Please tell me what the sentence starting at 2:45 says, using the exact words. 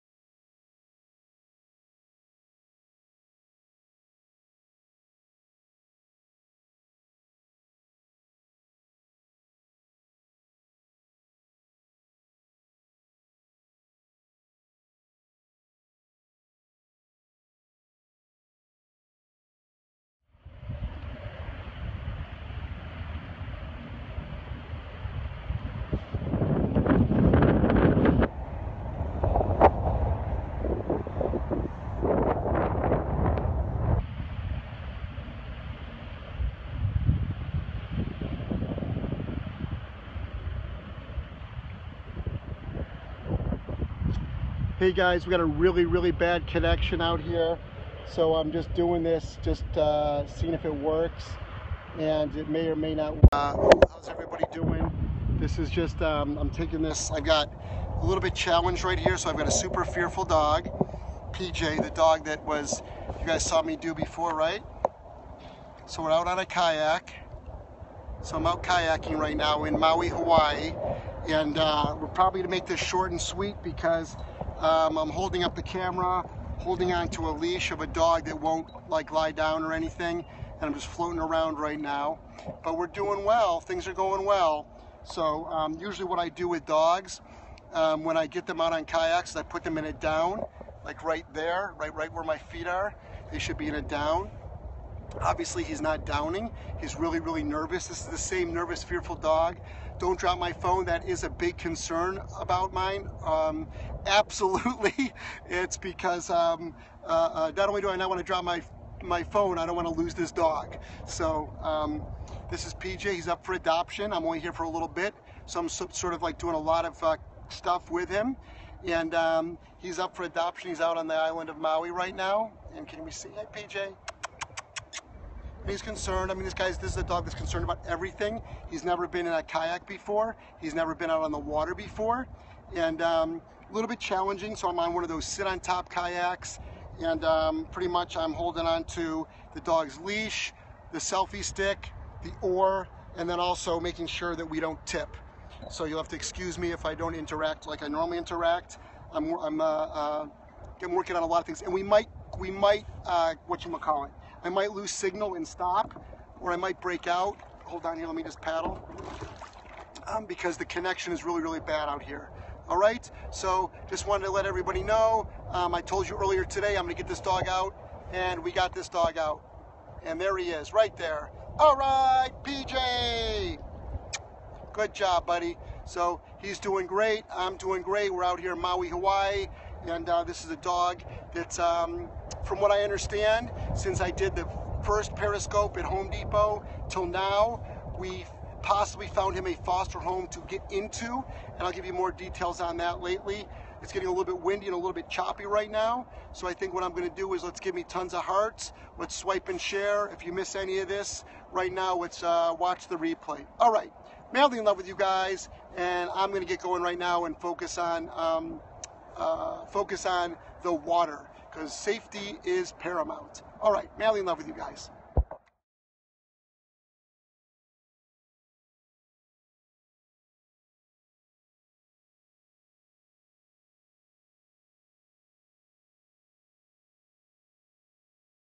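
Um, I told you earlier today I'm gonna get this dog out, and we got this dog out.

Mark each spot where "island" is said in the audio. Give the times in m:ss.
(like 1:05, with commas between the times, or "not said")
2:01.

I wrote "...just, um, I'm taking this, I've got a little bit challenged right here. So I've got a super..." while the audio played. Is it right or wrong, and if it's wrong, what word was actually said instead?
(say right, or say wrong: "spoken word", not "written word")
right.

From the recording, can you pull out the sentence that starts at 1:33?
They should be in a down.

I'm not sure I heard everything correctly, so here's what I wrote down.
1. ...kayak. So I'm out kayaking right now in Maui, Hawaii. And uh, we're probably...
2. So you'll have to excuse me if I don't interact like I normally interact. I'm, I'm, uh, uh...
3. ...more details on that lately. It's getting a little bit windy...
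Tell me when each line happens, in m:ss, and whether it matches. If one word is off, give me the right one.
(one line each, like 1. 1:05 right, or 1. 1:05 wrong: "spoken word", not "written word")
1. 1:06 right
2. 2:25 right
3. 3:11 right.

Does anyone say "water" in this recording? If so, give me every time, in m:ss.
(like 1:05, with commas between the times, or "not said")
2:11, 3:30.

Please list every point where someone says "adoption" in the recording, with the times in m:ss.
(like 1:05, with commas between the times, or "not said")
1:53, 2:00.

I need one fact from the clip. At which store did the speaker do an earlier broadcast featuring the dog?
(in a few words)
Home Depot.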